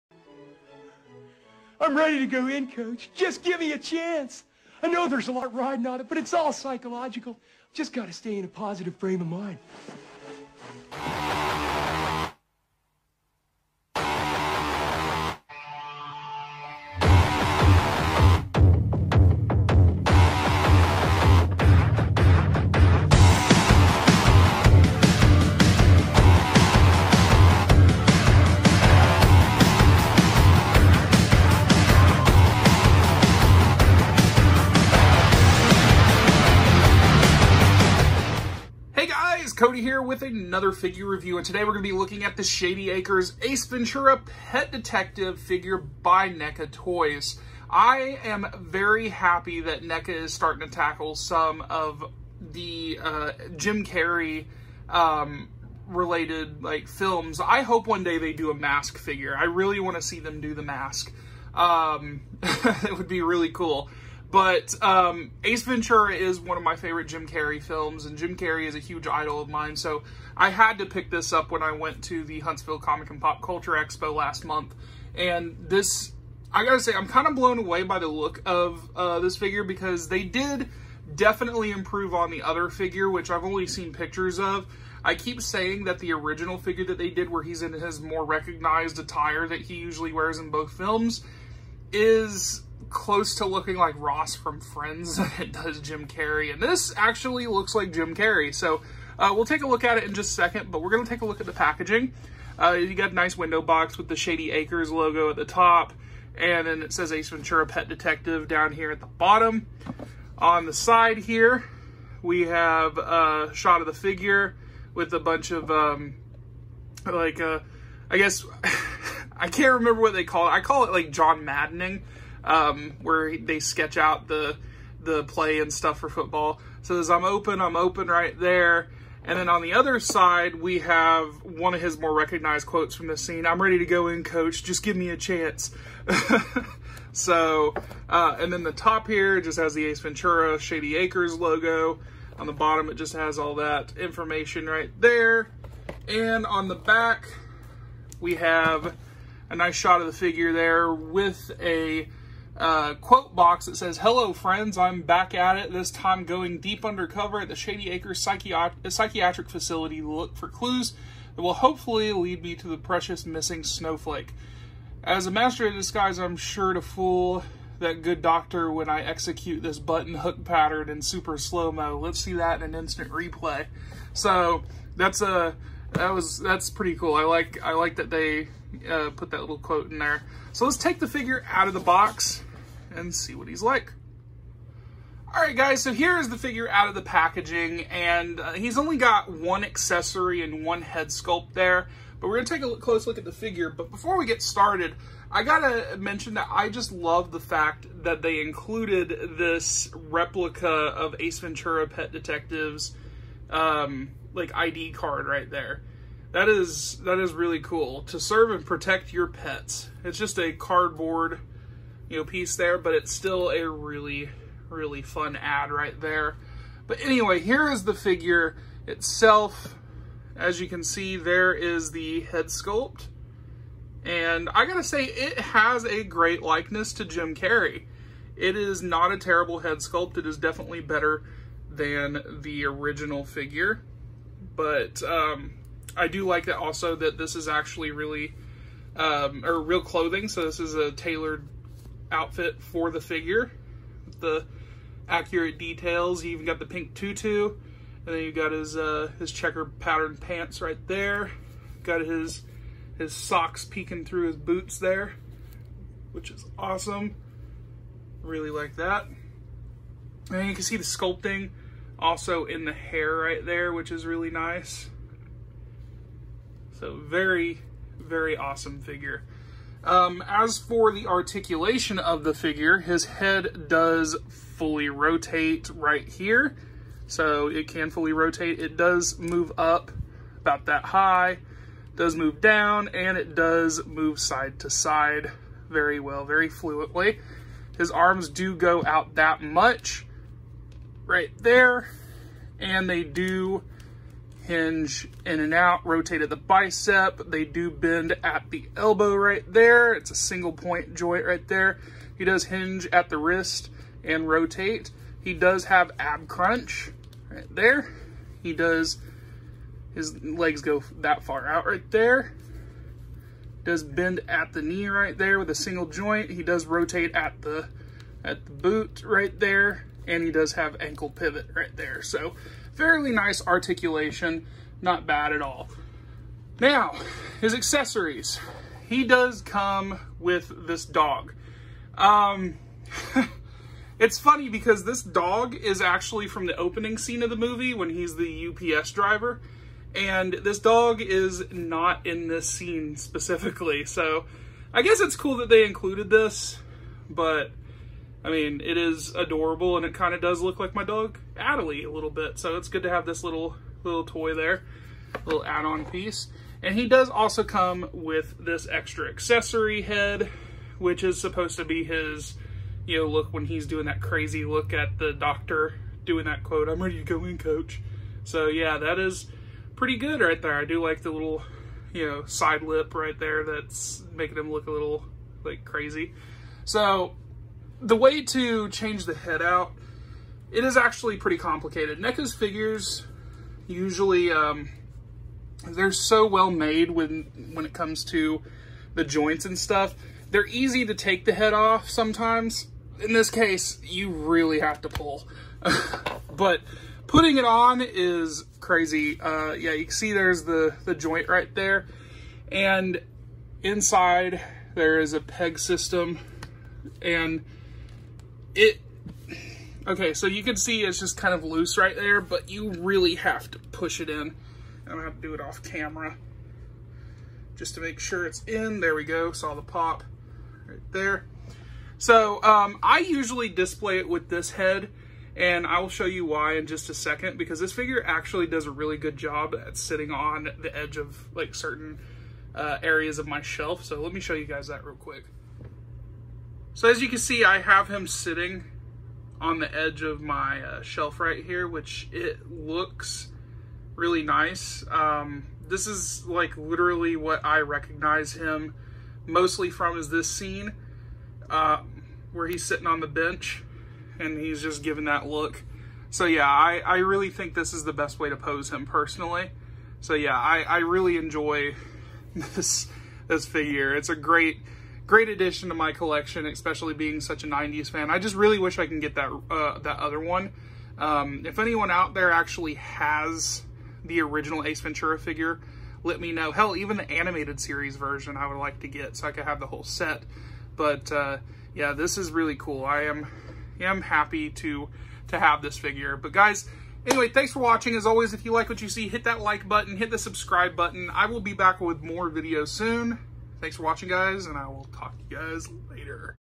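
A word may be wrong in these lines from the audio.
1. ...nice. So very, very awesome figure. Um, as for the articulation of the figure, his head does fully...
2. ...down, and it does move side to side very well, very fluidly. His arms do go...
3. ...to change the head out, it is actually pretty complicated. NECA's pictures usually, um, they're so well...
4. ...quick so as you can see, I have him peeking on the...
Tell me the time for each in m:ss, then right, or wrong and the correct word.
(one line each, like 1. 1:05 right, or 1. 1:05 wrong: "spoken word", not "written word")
1. 4:24 right
2. 4:42 right
3. 6:18 wrong: "figures", not "pictures"
4. 7:14 wrong: "sitting", not "peeking".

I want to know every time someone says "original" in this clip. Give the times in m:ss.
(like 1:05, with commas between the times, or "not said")
1:26, 3:52, 7:54.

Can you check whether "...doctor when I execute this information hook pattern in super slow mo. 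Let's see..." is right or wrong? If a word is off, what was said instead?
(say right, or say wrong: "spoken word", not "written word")
wrong: "button", not "information".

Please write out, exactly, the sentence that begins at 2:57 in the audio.
I like I like that they uh, put that little quote in there.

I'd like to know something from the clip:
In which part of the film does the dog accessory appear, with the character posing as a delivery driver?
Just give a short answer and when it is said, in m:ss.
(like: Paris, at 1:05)
The opening scene, at 5:36.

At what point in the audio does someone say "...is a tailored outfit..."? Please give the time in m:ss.
4:00.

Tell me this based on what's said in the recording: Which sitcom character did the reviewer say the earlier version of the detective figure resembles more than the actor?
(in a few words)
Ross from Friends.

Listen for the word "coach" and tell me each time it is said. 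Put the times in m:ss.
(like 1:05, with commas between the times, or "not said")
0:02, 2:14, 6:07.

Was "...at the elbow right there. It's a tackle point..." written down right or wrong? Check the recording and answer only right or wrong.
wrong.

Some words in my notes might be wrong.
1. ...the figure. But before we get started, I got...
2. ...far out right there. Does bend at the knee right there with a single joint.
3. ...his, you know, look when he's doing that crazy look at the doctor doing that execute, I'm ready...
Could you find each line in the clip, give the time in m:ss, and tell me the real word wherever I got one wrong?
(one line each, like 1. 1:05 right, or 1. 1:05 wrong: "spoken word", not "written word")
1. 3:13 right
2. 5:11 right
3. 6:01 wrong: "quote", not "execute".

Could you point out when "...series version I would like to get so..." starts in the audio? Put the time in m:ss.
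7:57.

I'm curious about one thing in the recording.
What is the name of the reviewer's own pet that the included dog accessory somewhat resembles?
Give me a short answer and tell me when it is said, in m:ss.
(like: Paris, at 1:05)
Adelie, at 5:51.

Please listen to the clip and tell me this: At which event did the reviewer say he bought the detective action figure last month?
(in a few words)
Huntsville Comic and Pop Culture Expo.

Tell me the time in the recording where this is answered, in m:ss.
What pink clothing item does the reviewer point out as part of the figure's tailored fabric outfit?
4:06.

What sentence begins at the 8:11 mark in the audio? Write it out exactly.
I will be back with more videos soon.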